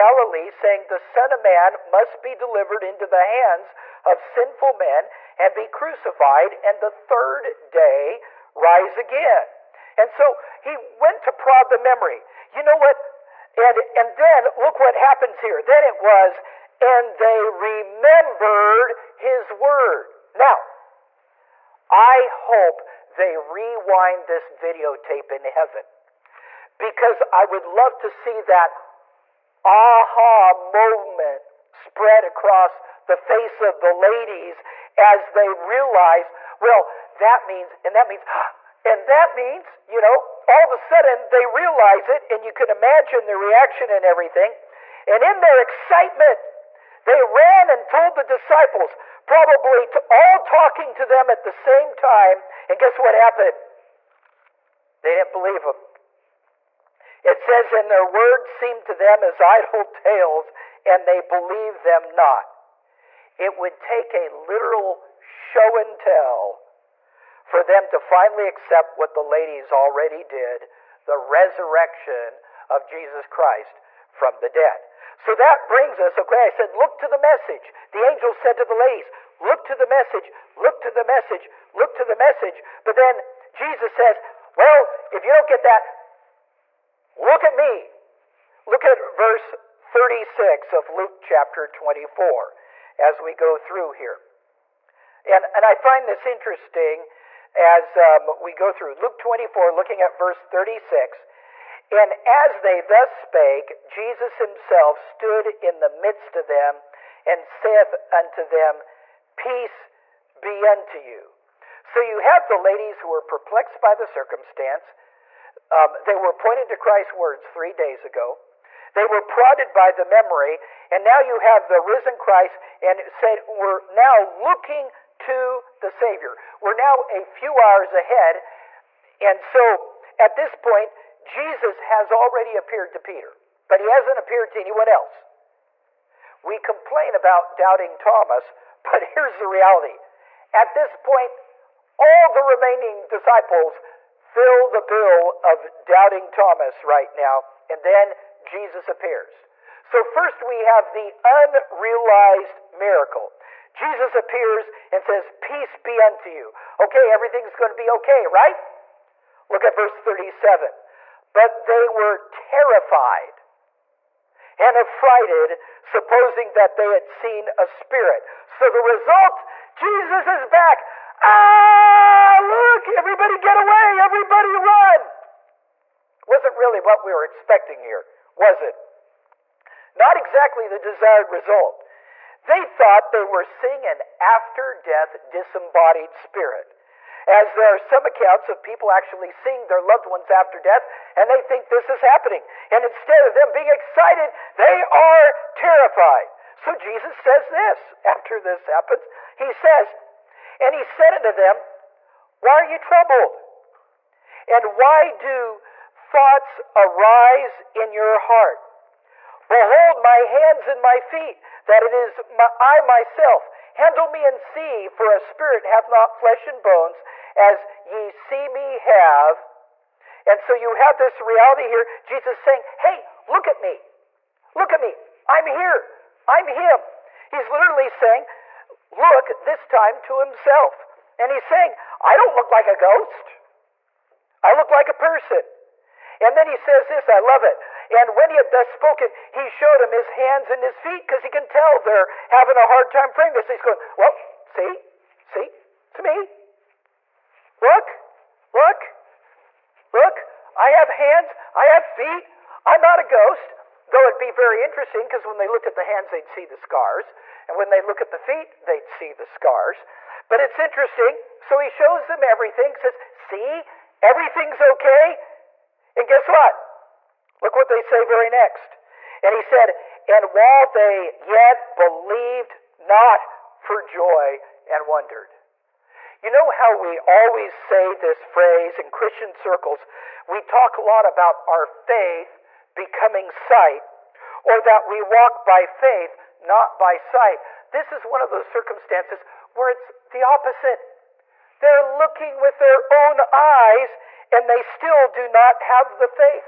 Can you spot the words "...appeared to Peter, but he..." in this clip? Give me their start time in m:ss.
2:12.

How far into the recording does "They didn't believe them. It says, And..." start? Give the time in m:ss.
0:55.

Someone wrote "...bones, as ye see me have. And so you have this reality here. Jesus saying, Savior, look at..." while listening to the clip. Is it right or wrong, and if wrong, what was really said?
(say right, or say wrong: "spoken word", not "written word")
wrong: "Hey", not "Savior".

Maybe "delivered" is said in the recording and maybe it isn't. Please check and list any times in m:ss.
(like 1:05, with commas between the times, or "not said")
0:02.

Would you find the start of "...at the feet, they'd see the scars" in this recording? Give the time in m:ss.
4:17.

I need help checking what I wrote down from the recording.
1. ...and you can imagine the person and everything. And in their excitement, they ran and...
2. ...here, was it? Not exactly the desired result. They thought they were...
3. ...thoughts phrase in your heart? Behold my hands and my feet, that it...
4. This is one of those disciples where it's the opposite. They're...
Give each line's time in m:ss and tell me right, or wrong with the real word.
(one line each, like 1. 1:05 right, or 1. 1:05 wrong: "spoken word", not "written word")
1. 0:42 wrong: "reaction", not "person"
2. 2:57 right
3. 3:25 wrong: "arise", not "phrase"
4. 4:47 wrong: "circumstances", not "disciples".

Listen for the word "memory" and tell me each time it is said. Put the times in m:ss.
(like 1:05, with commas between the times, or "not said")
0:11, 2:00.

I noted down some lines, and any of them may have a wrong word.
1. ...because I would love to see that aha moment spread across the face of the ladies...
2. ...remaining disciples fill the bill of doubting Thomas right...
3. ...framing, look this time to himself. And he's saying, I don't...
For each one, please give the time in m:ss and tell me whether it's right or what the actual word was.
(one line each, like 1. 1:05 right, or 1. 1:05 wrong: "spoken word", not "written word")
1. 0:26 right
2. 2:22 right
3. 3:47 wrong: "saying", not "framing".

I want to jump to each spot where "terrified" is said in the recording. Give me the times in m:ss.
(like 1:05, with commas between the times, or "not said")
2:42, 3:15.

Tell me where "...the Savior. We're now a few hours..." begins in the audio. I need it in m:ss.
2:05.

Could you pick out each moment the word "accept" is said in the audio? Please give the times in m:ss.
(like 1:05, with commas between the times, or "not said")
1:08.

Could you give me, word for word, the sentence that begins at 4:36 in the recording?
You know how we always say this phrase in Christian circles?